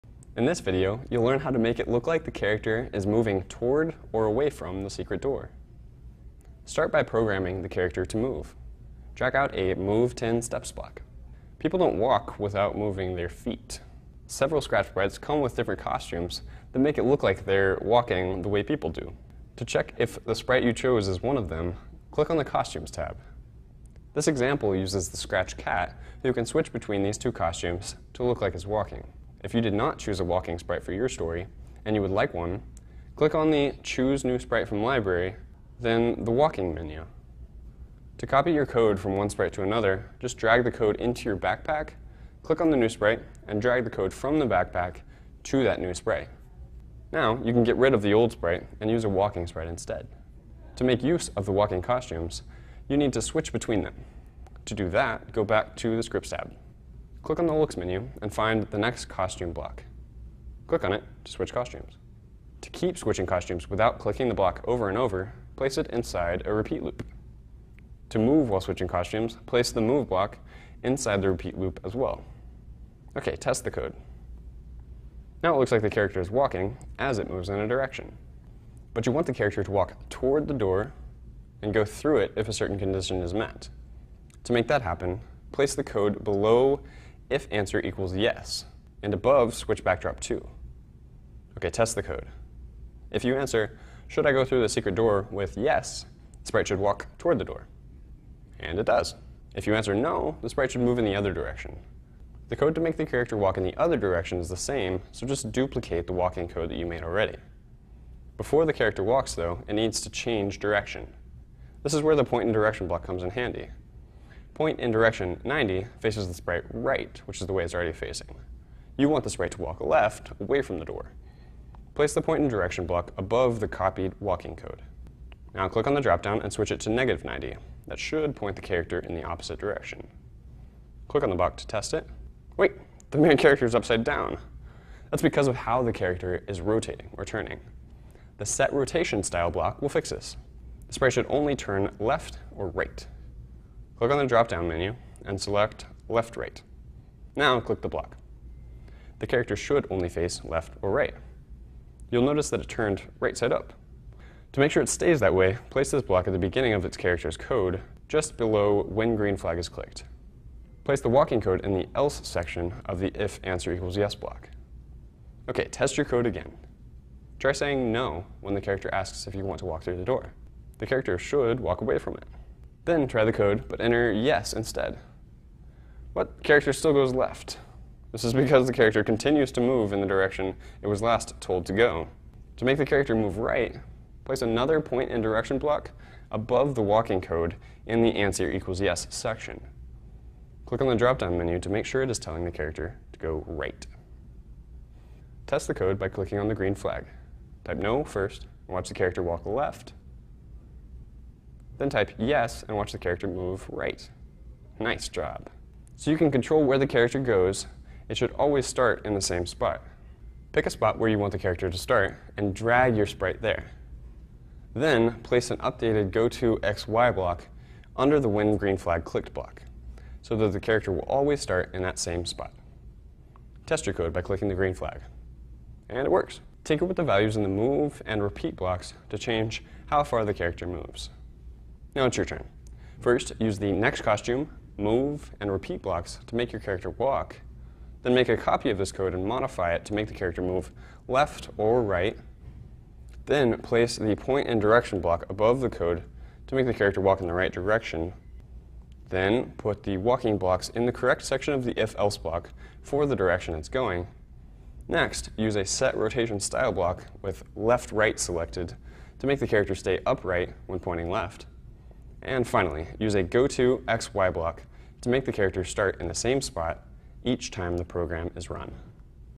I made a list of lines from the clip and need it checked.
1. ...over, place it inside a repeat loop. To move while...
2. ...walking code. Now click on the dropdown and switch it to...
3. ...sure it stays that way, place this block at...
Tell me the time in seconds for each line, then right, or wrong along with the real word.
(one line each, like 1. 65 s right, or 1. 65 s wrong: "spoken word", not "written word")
1. 64 s right
2. 124 s right
3. 154 s right.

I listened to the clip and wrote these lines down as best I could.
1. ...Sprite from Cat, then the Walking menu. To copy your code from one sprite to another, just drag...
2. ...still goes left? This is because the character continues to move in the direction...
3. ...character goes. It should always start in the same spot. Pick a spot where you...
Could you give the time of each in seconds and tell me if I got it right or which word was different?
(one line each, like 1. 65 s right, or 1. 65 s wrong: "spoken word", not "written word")
1. 34 s wrong: "Library", not "Cat"
2. 176 s right
3. 206 s right.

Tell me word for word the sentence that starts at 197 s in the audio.
Type no first and watch the character walk left then type yes and watch the character move right.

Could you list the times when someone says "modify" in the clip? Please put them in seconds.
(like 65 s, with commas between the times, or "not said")
239 s.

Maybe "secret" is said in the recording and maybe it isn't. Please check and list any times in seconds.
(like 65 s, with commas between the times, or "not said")
4 s, 94 s.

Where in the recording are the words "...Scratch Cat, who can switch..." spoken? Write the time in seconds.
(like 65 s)
25 s.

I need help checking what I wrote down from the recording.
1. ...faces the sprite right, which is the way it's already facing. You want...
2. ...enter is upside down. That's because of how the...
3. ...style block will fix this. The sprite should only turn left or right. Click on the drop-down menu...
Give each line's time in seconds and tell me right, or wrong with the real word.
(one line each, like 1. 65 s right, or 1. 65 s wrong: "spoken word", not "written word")
1. 115 s right
2. 133 s wrong: "character", not "enter"
3. 139 s right.